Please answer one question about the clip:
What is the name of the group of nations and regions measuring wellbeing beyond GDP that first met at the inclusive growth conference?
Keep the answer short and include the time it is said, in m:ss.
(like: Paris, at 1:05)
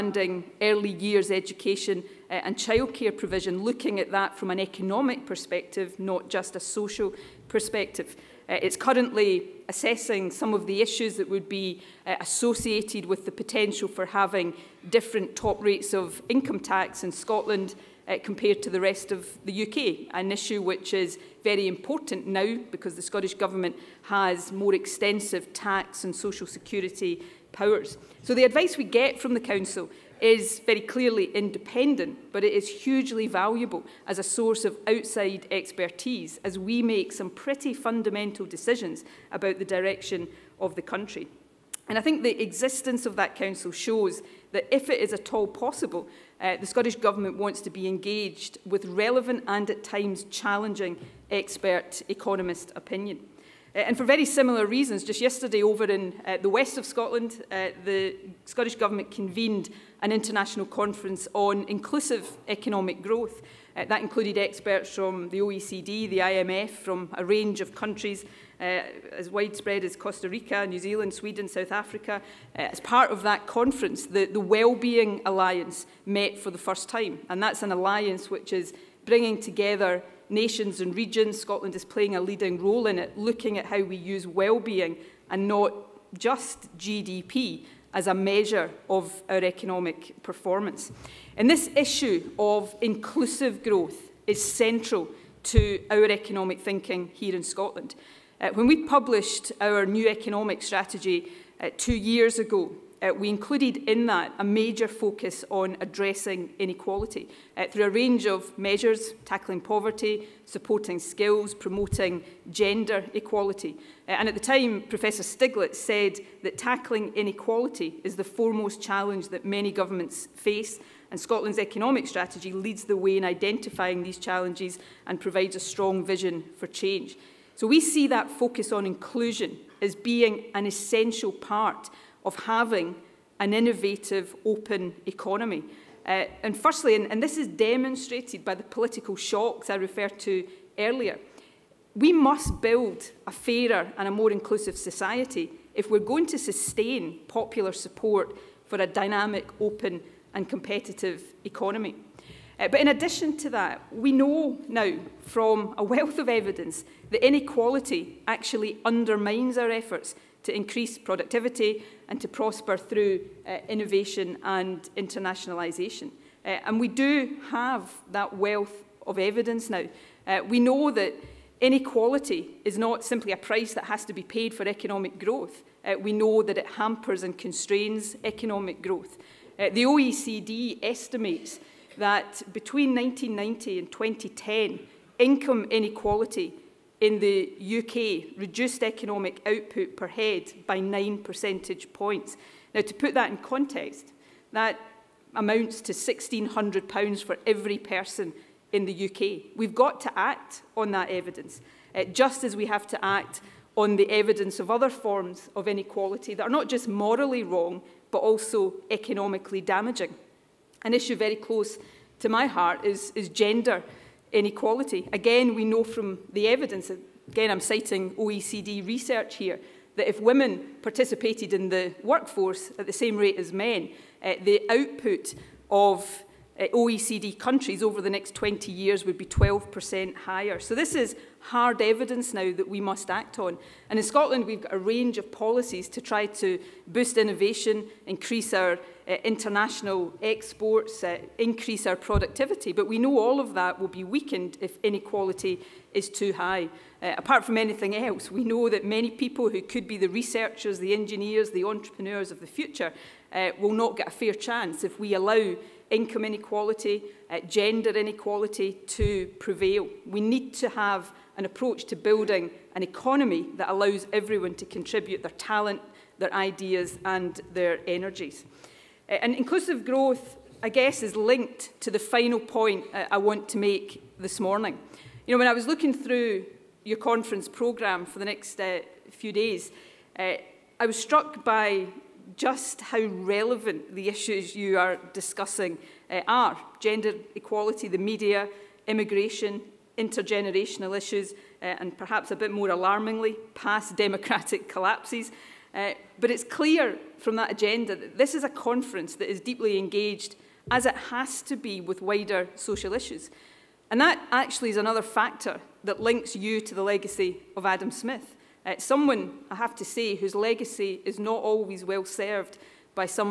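Wellbeing Alliance, at 1:14.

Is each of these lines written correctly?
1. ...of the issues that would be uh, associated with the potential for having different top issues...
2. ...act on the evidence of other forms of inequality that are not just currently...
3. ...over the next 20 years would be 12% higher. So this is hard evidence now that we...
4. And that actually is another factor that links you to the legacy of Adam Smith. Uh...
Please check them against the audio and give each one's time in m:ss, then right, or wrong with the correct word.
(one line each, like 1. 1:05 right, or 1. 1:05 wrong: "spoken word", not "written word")
1. 0:10 wrong: "rates", not "issues"
2. 3:23 wrong: "morally", not "currently"
3. 3:47 right
4. 5:03 right.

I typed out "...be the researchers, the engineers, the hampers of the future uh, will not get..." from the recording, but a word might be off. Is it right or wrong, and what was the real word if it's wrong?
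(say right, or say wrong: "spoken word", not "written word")
wrong: "entrepreneurs", not "hampers".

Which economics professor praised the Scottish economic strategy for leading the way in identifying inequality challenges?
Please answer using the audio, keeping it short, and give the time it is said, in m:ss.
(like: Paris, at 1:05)
Professor Stiglitz, at 1:54.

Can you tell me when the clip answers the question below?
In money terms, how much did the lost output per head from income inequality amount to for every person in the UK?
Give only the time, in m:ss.
3:15.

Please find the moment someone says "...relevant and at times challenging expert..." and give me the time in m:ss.
0:48.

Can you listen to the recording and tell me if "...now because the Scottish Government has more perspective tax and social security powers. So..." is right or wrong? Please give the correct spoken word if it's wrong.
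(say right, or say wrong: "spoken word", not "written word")
wrong: "extensive", not "perspective".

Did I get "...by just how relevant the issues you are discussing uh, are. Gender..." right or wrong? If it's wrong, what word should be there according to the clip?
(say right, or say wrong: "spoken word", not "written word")
right.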